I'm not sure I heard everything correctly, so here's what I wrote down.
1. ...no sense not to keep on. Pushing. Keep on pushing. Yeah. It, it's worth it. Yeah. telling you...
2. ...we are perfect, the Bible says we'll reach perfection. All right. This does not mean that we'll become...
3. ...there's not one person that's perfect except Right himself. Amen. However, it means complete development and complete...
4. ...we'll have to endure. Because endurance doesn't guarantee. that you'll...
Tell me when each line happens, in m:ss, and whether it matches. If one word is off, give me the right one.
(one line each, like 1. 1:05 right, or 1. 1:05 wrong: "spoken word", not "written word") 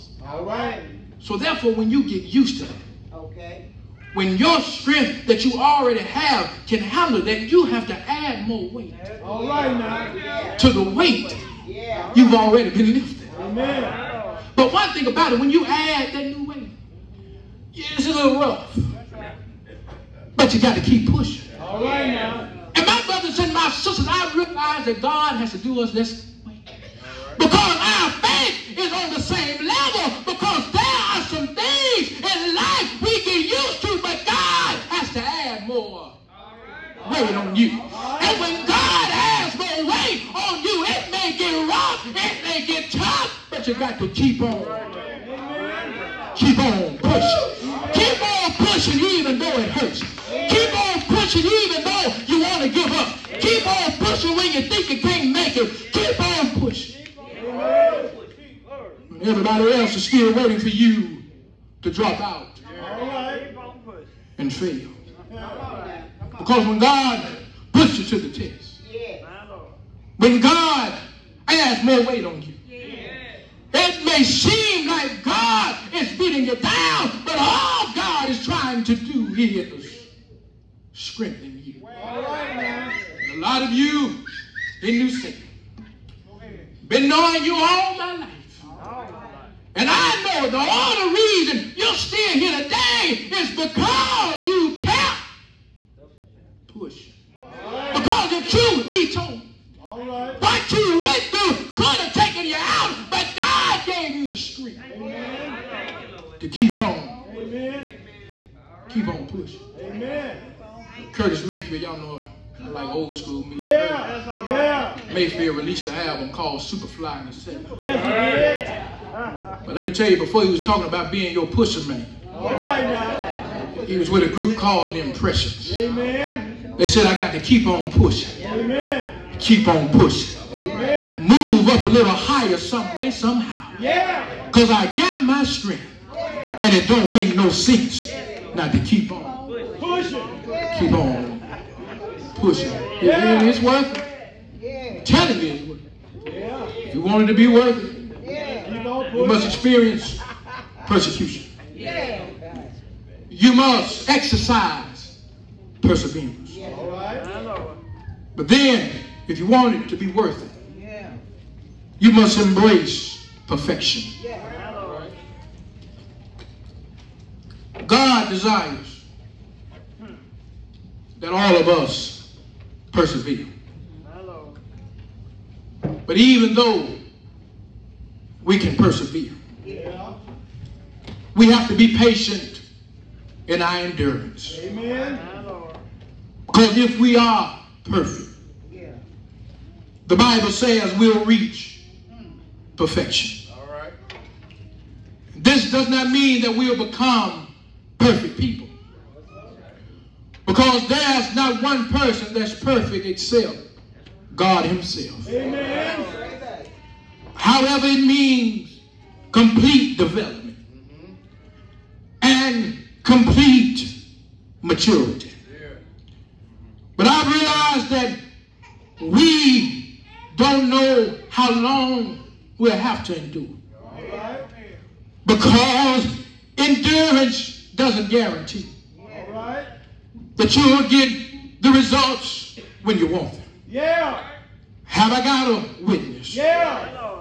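1. 2:17 right
2. 3:06 right
3. 3:20 wrong: "God", not "Right"
4. 3:42 right.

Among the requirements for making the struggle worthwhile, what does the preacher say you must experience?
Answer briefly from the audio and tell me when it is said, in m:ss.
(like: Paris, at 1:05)
persecution, at 2:30.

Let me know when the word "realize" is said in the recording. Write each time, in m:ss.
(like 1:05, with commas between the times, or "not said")
0:24, 3:37.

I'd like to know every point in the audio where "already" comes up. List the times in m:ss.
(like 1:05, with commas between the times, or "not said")
0:05, 0:12.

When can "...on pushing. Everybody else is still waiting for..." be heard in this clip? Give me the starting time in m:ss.
0:56.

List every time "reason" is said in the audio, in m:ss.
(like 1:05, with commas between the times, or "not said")
1:31.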